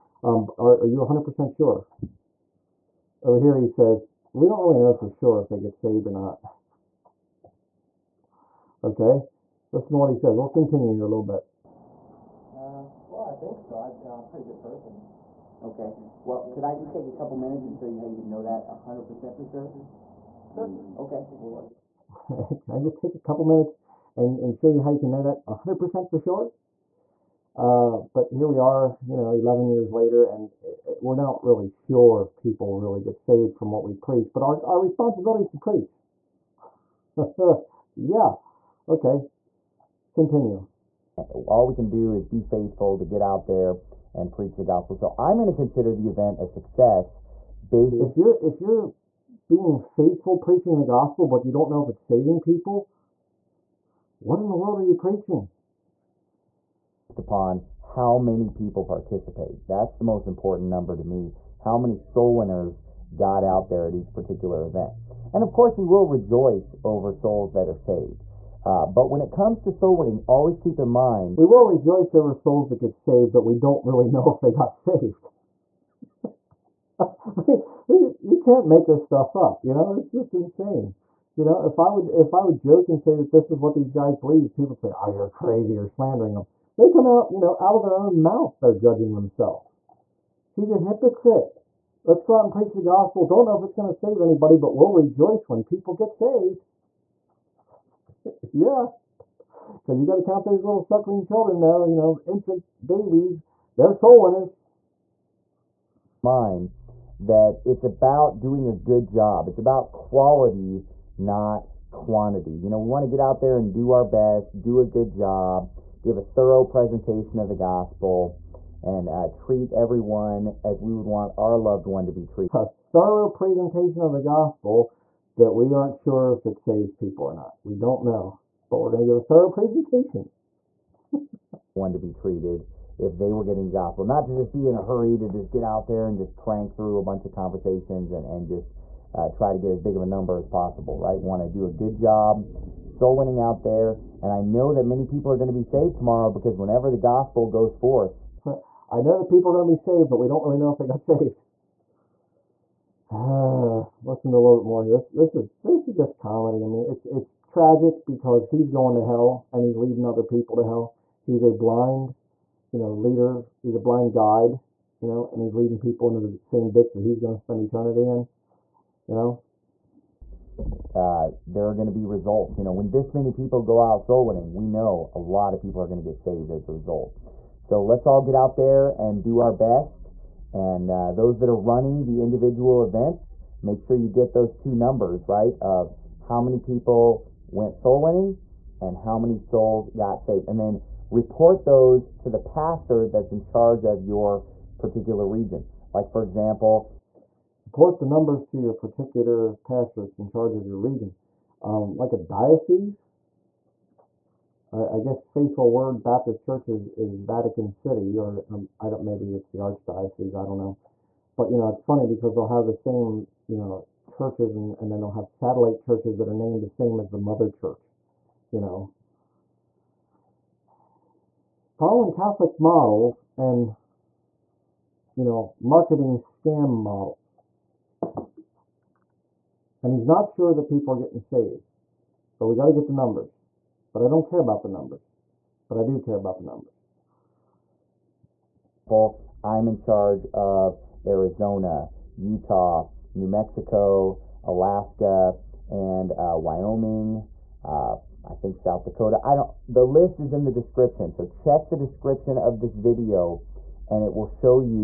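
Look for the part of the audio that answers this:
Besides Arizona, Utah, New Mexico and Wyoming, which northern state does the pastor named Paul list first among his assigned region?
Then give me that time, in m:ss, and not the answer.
4:04.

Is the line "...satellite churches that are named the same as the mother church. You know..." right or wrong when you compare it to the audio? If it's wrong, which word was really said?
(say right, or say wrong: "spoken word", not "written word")
right.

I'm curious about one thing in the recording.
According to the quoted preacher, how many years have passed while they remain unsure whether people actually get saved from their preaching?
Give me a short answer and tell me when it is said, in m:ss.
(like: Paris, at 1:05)
11, at 0:29.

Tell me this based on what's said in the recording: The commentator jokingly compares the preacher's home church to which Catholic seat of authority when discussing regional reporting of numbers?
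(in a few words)
Vatican City.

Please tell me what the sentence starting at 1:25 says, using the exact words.
You're slandering them." They come out, you know, out of their own mouth, they're judging themselves.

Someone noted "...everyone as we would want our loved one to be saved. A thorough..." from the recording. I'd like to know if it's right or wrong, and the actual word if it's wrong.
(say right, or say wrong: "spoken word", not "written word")
wrong: "treated", not "saved".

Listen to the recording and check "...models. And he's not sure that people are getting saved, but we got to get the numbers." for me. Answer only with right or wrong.
right.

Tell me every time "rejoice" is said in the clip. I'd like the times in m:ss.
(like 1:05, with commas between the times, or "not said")
1:06, 1:11, 1:34.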